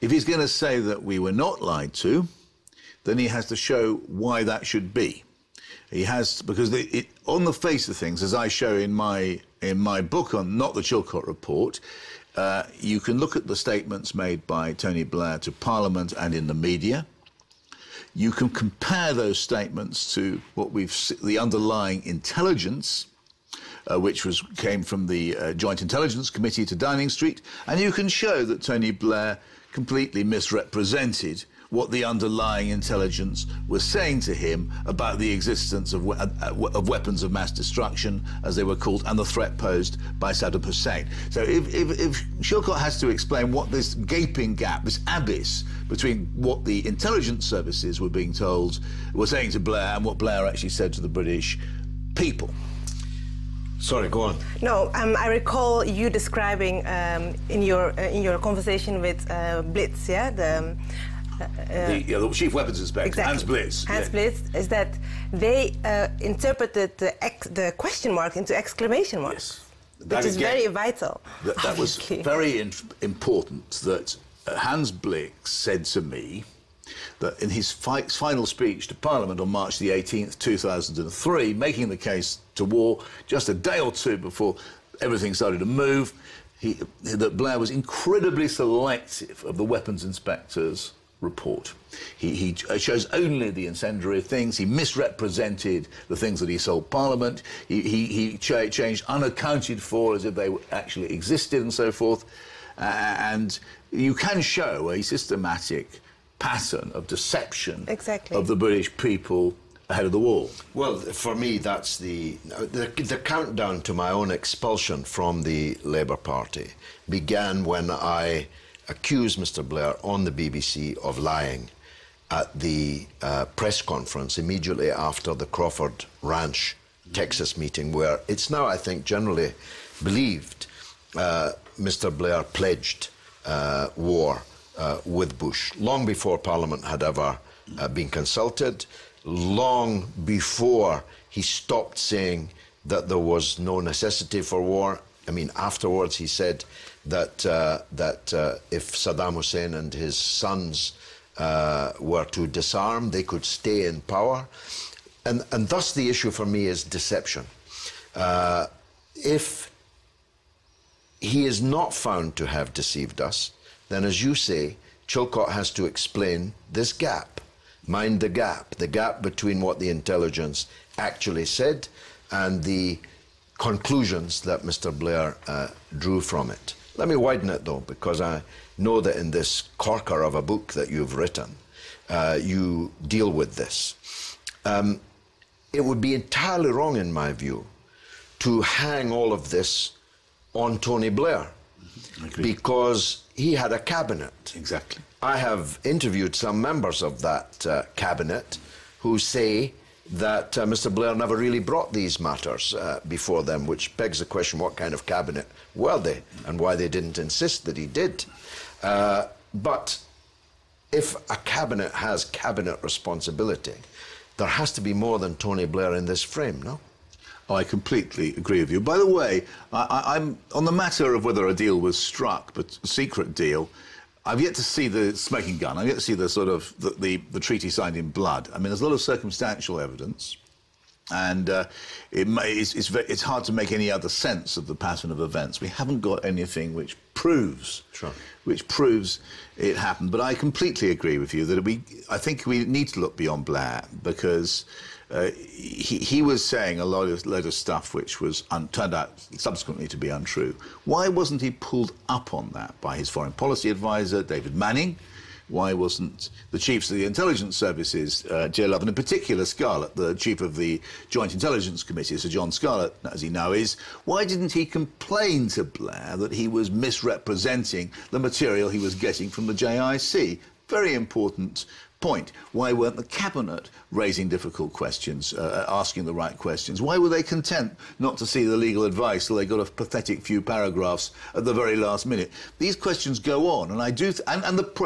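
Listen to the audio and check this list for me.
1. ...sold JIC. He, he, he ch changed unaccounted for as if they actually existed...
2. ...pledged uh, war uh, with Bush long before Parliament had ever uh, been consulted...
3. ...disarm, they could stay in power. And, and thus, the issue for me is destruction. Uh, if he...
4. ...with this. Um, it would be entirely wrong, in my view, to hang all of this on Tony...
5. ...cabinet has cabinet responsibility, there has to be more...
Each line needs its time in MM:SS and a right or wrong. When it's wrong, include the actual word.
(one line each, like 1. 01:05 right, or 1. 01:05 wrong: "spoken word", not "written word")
1. 01:36 wrong: "Parliament", not "JIC"
2. 02:12 right
3. 02:32 wrong: "deception", not "destruction"
4. 03:03 right
5. 03:31 right.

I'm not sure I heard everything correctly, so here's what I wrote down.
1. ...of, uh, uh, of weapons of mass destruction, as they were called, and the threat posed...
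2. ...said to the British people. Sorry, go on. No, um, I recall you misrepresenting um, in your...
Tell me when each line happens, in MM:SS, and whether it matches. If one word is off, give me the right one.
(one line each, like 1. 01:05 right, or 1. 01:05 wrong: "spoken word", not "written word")
1. 00:35 right
2. 00:50 wrong: "describing", not "misrepresenting".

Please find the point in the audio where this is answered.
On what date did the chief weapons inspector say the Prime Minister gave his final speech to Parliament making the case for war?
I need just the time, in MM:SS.
01:19.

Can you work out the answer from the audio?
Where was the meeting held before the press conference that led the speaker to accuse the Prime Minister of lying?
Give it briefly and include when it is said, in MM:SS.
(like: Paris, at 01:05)
Crawford Ranch, Texas, at 02:05.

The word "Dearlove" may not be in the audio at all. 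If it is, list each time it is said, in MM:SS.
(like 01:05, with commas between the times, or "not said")
04:18.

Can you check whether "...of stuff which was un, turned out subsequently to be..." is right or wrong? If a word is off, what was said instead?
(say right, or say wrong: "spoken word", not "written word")
right.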